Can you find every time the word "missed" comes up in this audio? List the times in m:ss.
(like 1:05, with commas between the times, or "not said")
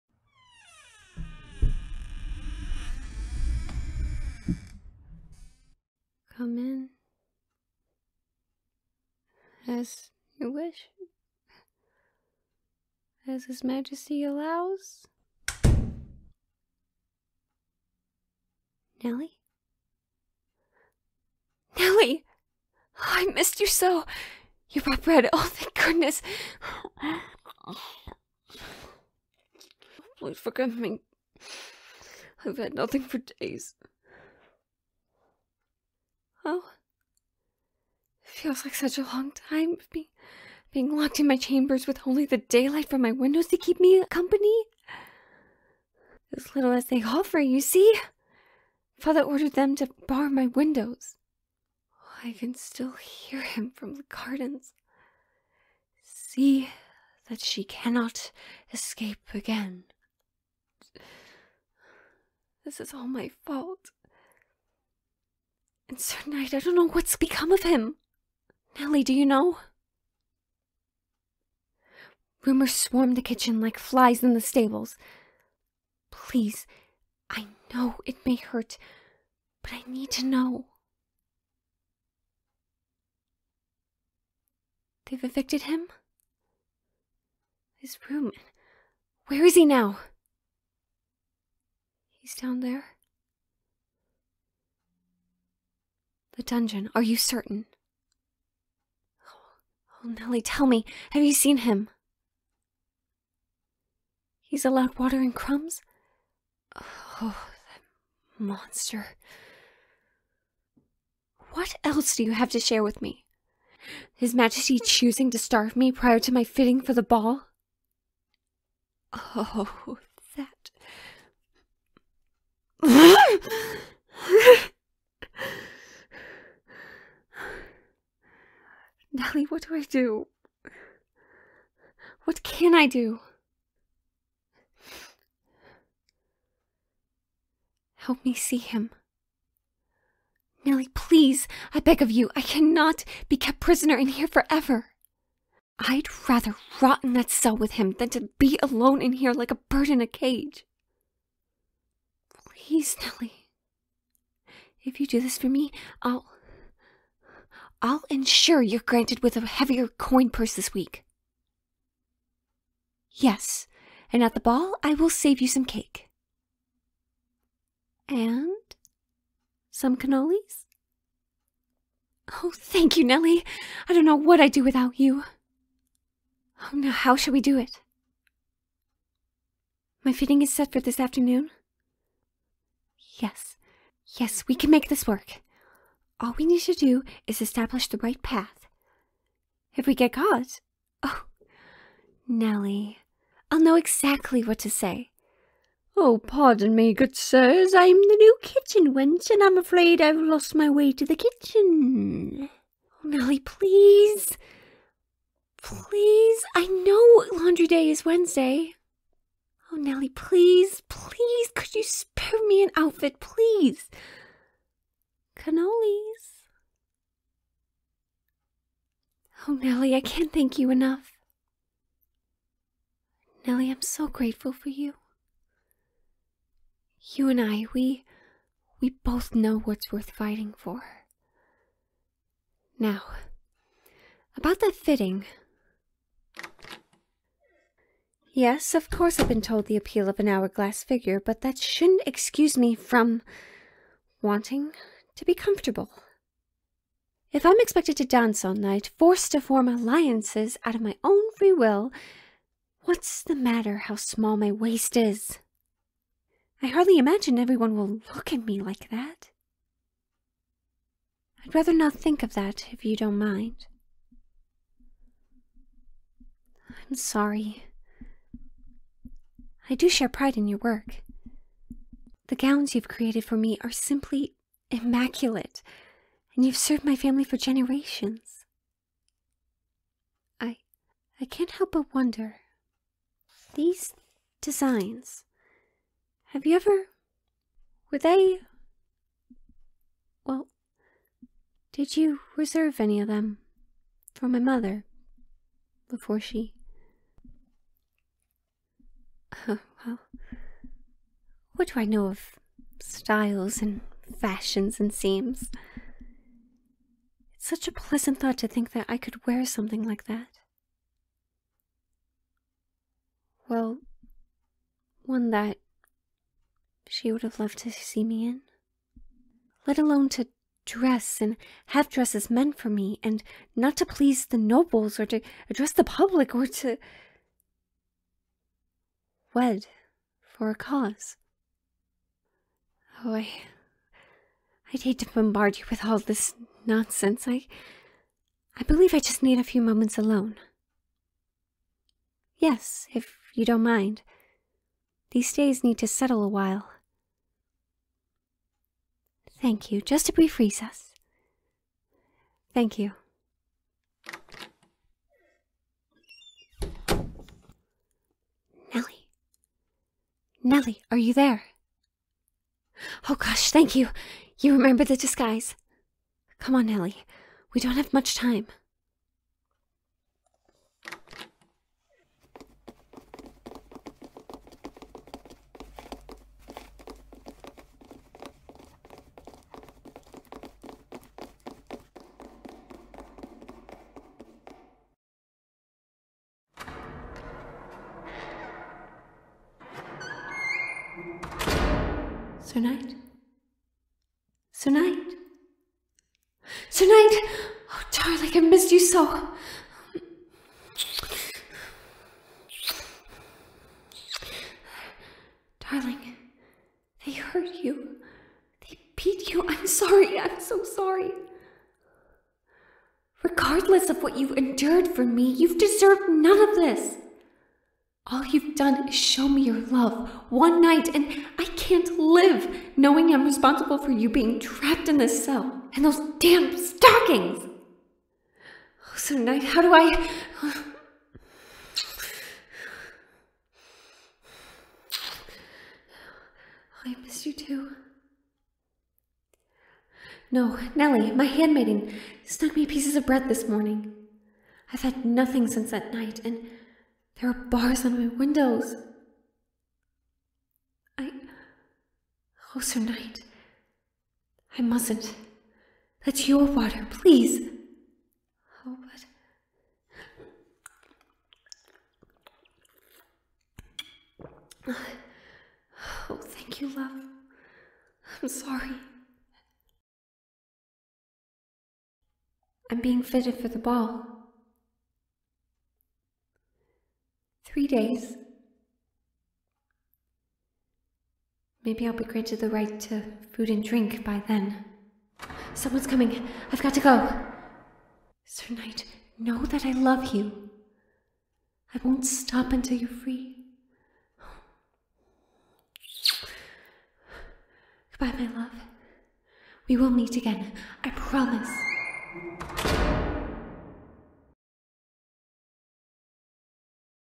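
0:23, 6:38, 7:17.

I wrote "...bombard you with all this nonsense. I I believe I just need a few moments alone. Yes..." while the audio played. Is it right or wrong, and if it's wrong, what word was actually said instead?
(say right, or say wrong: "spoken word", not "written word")
right.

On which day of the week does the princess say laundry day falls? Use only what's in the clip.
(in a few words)
Wednesday.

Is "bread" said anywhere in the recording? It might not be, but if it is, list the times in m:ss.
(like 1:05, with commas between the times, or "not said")
0:25, 7:23.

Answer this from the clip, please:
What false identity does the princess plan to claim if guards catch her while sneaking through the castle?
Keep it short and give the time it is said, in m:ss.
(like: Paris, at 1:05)
New kitchen wench, at 3:17.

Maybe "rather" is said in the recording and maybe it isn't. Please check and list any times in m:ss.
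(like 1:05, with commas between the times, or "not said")
2:26, 4:21.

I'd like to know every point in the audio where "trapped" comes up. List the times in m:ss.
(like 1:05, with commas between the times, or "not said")
7:04.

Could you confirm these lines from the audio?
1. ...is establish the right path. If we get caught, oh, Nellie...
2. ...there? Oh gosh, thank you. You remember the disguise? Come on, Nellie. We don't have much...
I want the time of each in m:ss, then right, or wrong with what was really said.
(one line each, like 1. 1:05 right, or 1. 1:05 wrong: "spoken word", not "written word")
1. 3:07 right
2. 6:01 right.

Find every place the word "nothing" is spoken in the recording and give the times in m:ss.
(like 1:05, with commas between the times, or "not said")
0:32, 7:25.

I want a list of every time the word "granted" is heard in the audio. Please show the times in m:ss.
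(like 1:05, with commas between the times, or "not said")
2:38, 8:02.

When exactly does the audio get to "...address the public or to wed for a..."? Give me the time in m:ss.
5:25.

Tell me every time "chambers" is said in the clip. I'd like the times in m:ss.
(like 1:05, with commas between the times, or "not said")
0:41.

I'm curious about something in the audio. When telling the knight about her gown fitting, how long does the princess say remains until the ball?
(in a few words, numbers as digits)
3 days.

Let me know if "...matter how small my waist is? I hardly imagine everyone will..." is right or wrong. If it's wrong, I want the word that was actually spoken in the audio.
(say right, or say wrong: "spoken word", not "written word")
right.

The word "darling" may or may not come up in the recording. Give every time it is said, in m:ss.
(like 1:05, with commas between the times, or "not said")
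6:37, 6:45.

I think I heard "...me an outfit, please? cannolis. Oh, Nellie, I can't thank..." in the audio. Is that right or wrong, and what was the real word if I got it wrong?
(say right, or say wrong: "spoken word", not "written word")
right.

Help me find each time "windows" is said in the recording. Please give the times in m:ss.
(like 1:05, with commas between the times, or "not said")
0:43, 0:50, 7:28.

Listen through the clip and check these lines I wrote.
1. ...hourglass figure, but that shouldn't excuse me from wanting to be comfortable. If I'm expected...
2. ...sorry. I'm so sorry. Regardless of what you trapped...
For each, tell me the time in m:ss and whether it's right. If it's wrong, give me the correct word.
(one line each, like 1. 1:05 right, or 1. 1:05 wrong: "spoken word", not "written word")
1. 4:00 right
2. 6:49 wrong: "endured", not "trapped".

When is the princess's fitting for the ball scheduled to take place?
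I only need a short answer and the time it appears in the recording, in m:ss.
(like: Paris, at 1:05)
This afternoon, at 3:00.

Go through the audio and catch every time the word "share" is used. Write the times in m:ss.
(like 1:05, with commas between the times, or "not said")
1:52, 4:29.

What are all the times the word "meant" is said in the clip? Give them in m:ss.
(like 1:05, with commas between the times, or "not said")
5:22.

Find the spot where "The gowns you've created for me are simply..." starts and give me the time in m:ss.
4:32.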